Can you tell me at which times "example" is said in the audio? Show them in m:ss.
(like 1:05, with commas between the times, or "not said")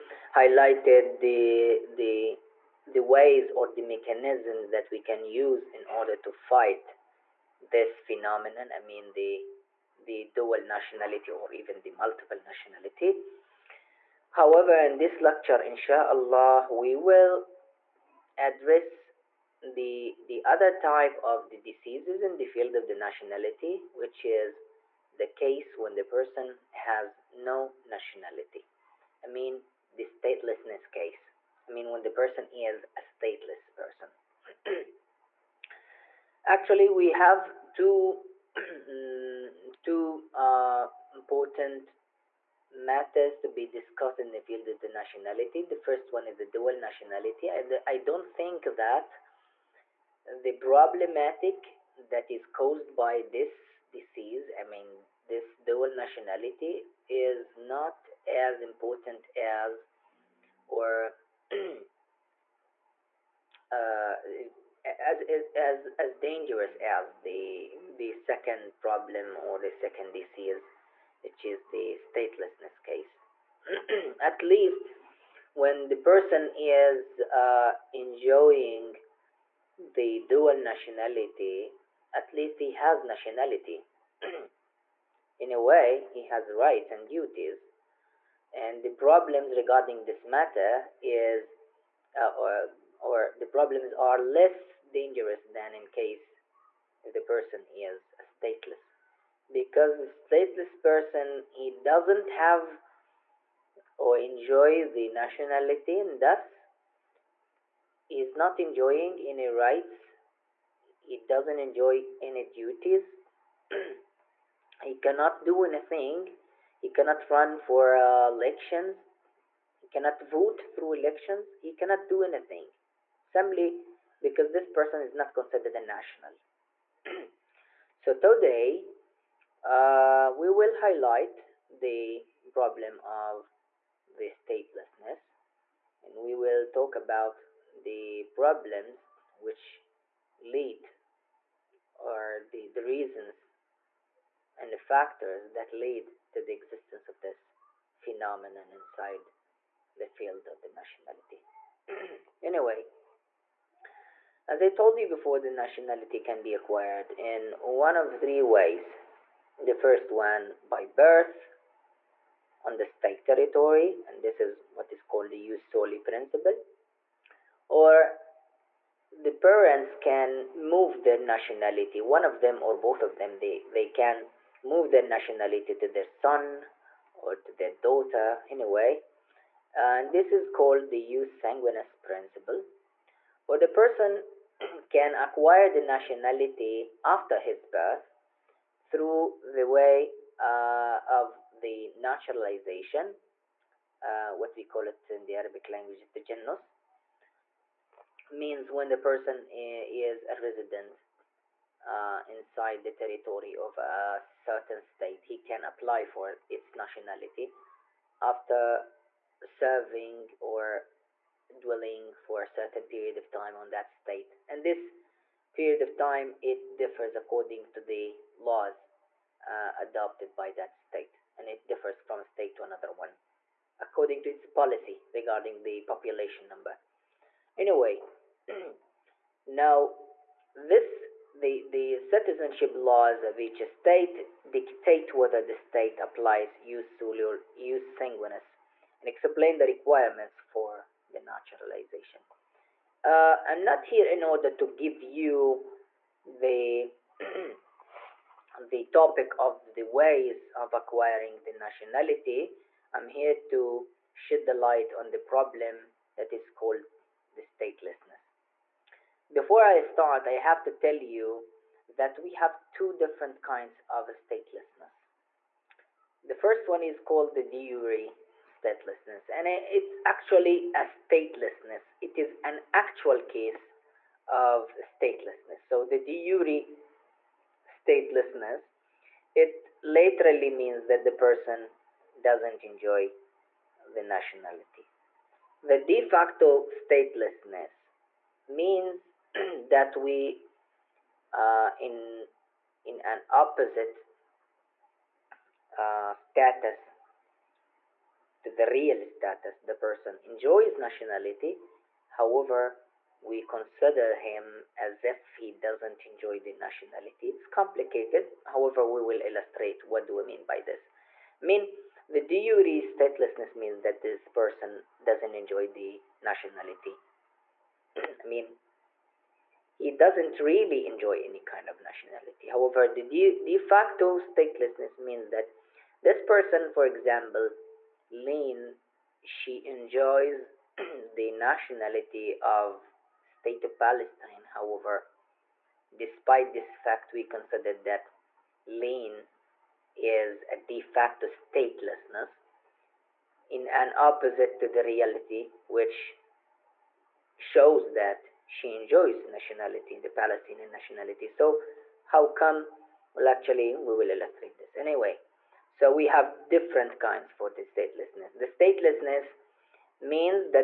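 5:26.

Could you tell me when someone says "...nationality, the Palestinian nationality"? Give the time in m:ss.
5:49.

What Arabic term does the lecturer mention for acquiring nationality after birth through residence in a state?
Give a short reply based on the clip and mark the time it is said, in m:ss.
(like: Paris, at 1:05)
jenos, at 3:16.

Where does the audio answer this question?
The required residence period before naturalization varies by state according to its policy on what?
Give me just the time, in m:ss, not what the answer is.
3:45.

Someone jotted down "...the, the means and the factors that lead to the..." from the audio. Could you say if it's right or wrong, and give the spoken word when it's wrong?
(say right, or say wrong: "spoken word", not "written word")
wrong: "reasons", not "means".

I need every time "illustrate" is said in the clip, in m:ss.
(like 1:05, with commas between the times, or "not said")
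5:09, 5:54.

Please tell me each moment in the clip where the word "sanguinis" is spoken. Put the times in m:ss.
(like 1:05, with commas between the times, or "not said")
3:01, 3:57.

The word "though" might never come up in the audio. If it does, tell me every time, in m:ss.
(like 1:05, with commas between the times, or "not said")
not said.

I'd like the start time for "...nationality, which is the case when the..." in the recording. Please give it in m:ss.
0:22.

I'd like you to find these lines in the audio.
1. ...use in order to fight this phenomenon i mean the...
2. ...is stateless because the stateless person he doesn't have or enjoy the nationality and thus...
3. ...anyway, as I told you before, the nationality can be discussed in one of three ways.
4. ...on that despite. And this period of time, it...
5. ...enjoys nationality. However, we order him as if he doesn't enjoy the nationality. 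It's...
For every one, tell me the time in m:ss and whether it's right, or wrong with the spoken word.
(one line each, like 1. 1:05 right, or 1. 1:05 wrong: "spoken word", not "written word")
1. 0:05 right
2. 1:37 right
3. 2:32 wrong: "acquired", not "discussed"
4. 3:33 wrong: "state", not "despite"
5. 5:00 wrong: "consider", not "order".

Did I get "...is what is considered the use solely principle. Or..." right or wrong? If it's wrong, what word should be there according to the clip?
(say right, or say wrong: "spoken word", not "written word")
wrong: "called", not "considered".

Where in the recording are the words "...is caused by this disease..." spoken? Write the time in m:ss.
0:52.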